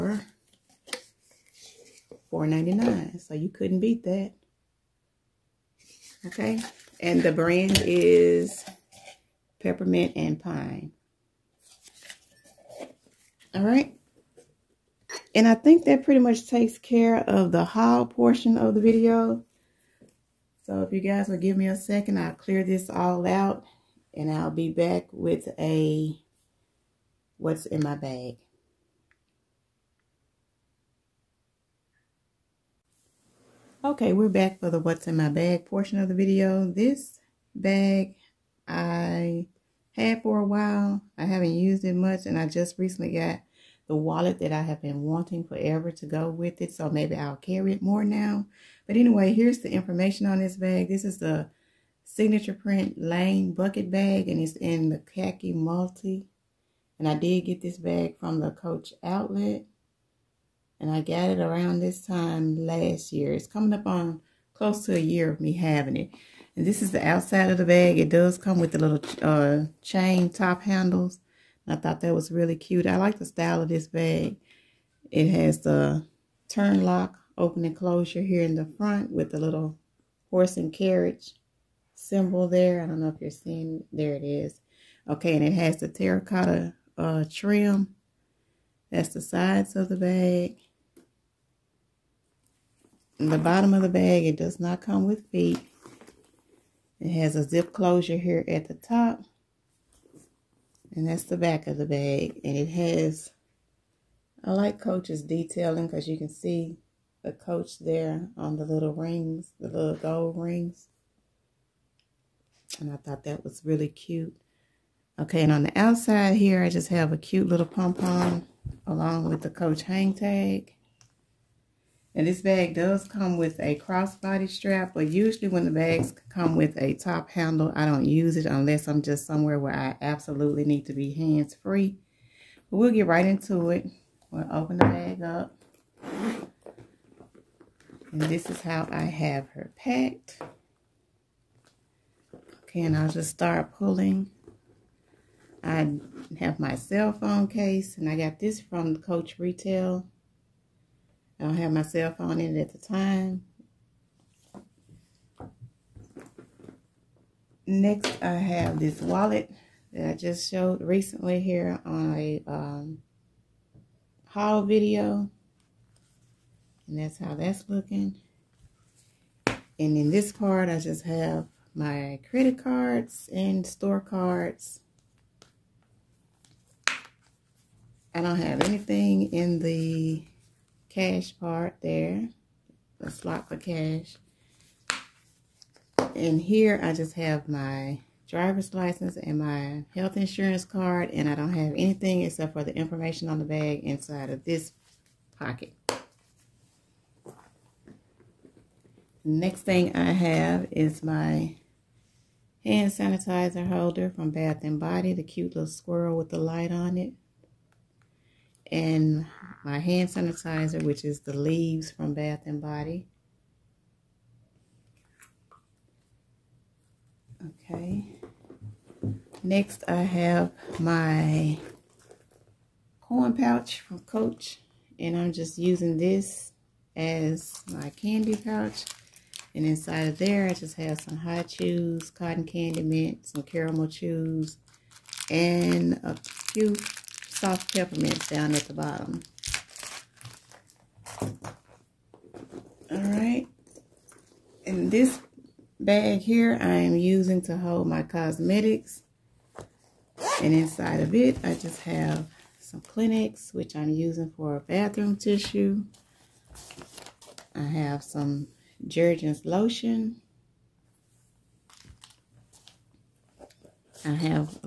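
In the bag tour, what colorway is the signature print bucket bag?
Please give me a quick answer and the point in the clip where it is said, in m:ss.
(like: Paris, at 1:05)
khaki multi, at 0:54.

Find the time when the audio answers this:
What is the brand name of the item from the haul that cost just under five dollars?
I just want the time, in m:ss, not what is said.
0:09.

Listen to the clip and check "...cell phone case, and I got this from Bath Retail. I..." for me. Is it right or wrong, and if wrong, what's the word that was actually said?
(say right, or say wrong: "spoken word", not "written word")
wrong: "Coach", not "Bath".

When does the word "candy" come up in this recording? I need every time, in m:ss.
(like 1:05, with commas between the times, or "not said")
3:47, 3:52.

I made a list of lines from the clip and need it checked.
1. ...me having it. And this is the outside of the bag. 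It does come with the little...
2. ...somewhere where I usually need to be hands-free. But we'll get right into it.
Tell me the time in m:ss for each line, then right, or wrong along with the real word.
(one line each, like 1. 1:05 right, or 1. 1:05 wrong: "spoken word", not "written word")
1. 1:05 right
2. 2:09 wrong: "absolutely", not "usually".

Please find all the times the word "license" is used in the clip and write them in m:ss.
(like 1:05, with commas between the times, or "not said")
3:08.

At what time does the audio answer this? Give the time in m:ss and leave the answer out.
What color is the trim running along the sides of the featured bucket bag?
1:25.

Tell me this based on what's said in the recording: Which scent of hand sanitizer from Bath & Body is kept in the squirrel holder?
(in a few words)
Leaves.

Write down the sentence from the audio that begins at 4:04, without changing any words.
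this bag here I am using to hold my cosmetics.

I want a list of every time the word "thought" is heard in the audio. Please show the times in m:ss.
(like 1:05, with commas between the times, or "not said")
1:11, 1:52.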